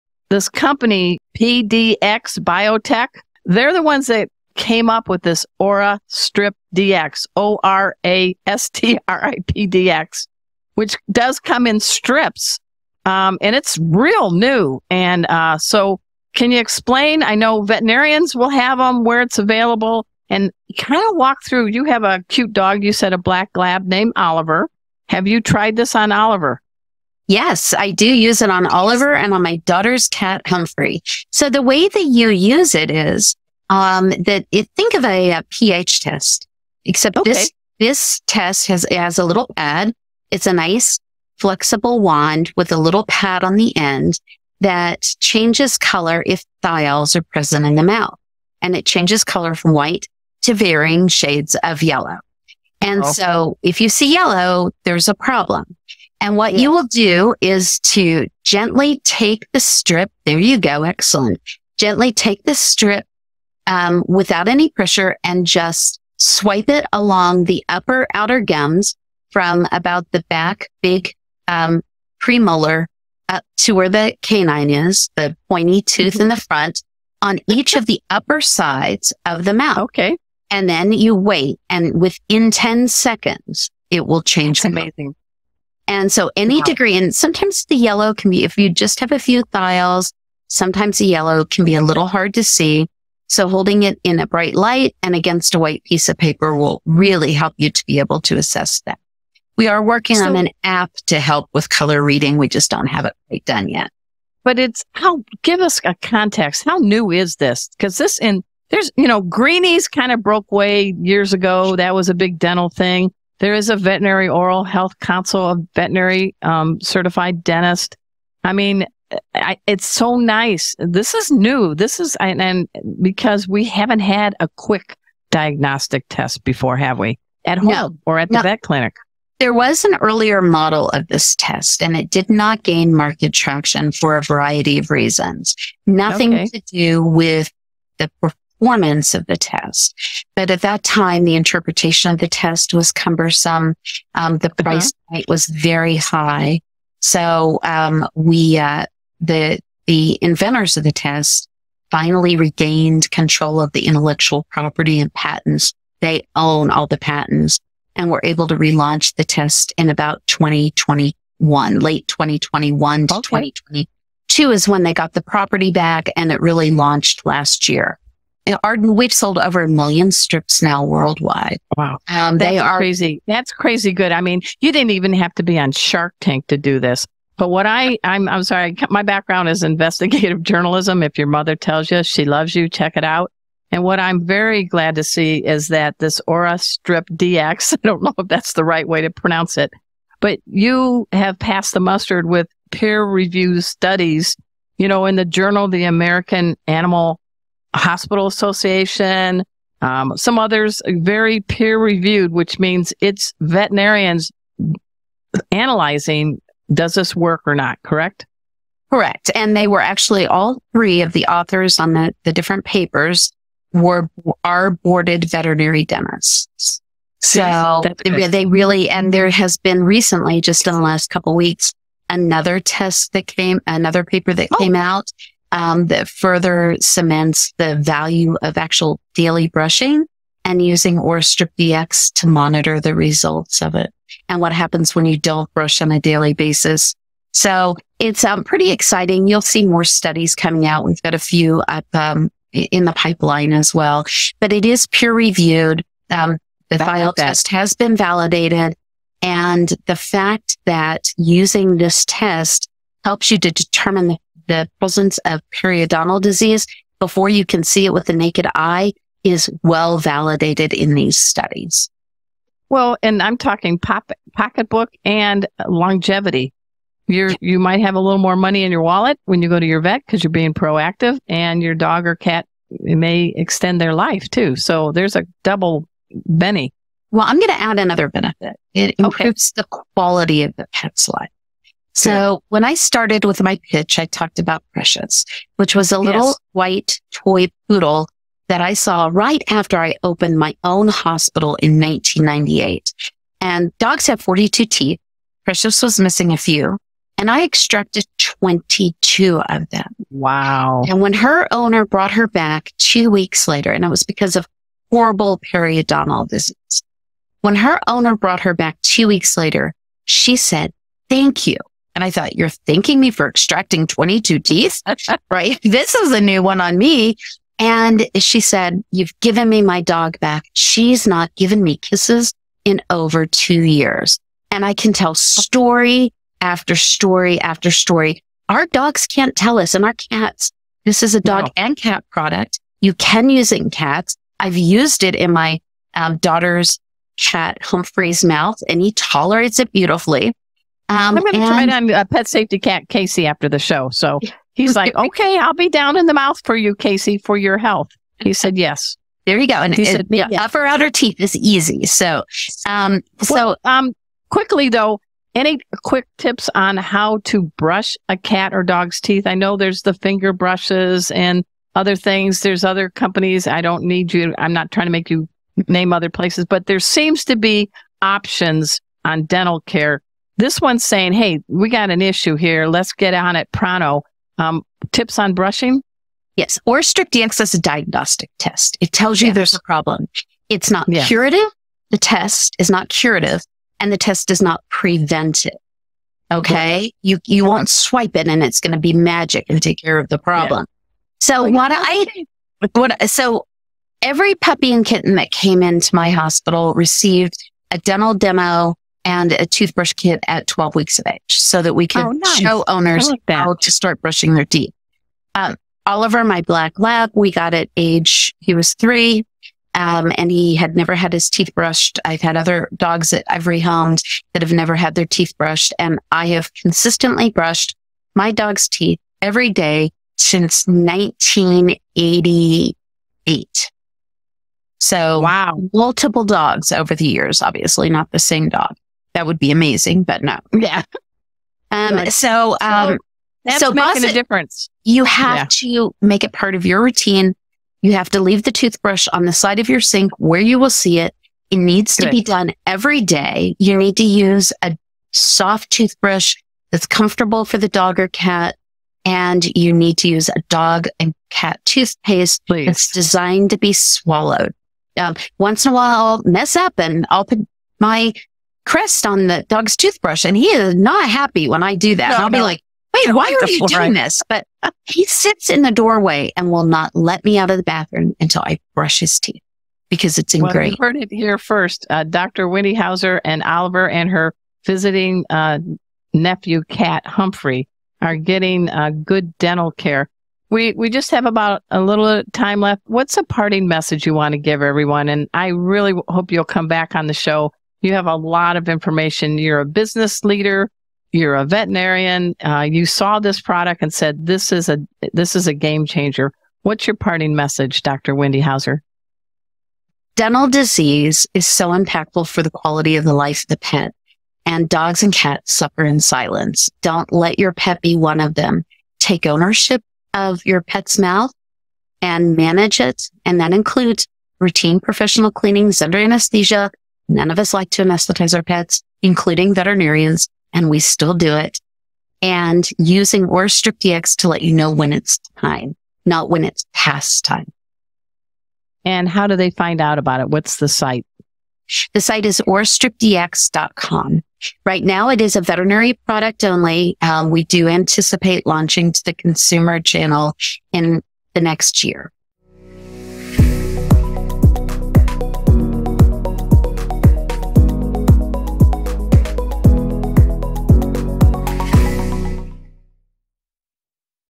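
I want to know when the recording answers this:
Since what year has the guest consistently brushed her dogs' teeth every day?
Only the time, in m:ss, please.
7:00.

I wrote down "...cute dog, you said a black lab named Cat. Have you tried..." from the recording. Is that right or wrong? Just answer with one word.
wrong.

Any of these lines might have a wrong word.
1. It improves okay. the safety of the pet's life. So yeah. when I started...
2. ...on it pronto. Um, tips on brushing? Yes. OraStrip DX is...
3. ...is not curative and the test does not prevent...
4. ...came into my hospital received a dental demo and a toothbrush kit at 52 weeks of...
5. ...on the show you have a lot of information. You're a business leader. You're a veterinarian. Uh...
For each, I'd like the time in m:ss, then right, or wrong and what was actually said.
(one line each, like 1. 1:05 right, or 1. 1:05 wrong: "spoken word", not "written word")
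1. 4:38 wrong: "quality", not "safety"
2. 6:13 right
3. 6:22 right
4. 6:35 wrong: "12", not "52"
5. 8:06 right.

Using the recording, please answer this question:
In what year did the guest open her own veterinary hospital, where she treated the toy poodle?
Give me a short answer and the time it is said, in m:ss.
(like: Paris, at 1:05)
1998, at 4:51.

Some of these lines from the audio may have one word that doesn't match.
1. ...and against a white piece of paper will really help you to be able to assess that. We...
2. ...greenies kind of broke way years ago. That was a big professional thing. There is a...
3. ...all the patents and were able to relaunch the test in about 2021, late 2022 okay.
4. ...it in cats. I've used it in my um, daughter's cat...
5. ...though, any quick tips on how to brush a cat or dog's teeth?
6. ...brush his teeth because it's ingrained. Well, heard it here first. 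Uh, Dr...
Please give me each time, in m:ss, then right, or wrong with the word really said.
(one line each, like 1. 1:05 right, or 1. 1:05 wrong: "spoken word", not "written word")
1. 1:35 right
2. 1:49 wrong: "dental", not "professional"
3. 2:36 wrong: "2021", not "2022"
4. 5:33 right
5. 5:54 right
6. 7:48 right.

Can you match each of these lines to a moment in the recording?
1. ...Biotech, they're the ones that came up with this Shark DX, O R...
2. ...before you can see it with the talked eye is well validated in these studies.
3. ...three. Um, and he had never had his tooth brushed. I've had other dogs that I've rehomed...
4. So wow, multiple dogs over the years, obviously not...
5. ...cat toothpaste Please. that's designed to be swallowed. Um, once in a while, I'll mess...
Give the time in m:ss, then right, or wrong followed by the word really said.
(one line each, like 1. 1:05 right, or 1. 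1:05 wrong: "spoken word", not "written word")
1. 0:02 wrong: "OraStrip", not "Shark"
2. 4:16 wrong: "naked", not "talked"
3. 6:48 wrong: "teeth", not "tooth"
4. 7:04 right
5. 7:31 right.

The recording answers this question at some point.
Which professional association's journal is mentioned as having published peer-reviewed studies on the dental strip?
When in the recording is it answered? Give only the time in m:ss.
3:15.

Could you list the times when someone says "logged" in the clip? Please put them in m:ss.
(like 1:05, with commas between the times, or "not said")
not said.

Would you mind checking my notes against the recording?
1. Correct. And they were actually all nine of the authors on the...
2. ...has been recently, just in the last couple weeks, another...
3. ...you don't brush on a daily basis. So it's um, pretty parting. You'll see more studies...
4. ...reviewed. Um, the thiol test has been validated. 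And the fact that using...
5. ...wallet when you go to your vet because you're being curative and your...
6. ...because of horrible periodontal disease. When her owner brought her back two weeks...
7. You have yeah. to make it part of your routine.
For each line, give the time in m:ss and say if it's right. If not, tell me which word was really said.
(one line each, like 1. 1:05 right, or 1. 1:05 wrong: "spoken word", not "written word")
1. 3:28 wrong: "three", not "nine"
2. 3:39 right
3. 3:55 wrong: "exciting", not "parting"
4. 4:05 right
5. 4:28 wrong: "proactive", not "curative"
6. 5:04 right
7. 7:14 right.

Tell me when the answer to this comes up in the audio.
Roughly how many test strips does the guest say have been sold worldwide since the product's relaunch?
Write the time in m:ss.
2:49.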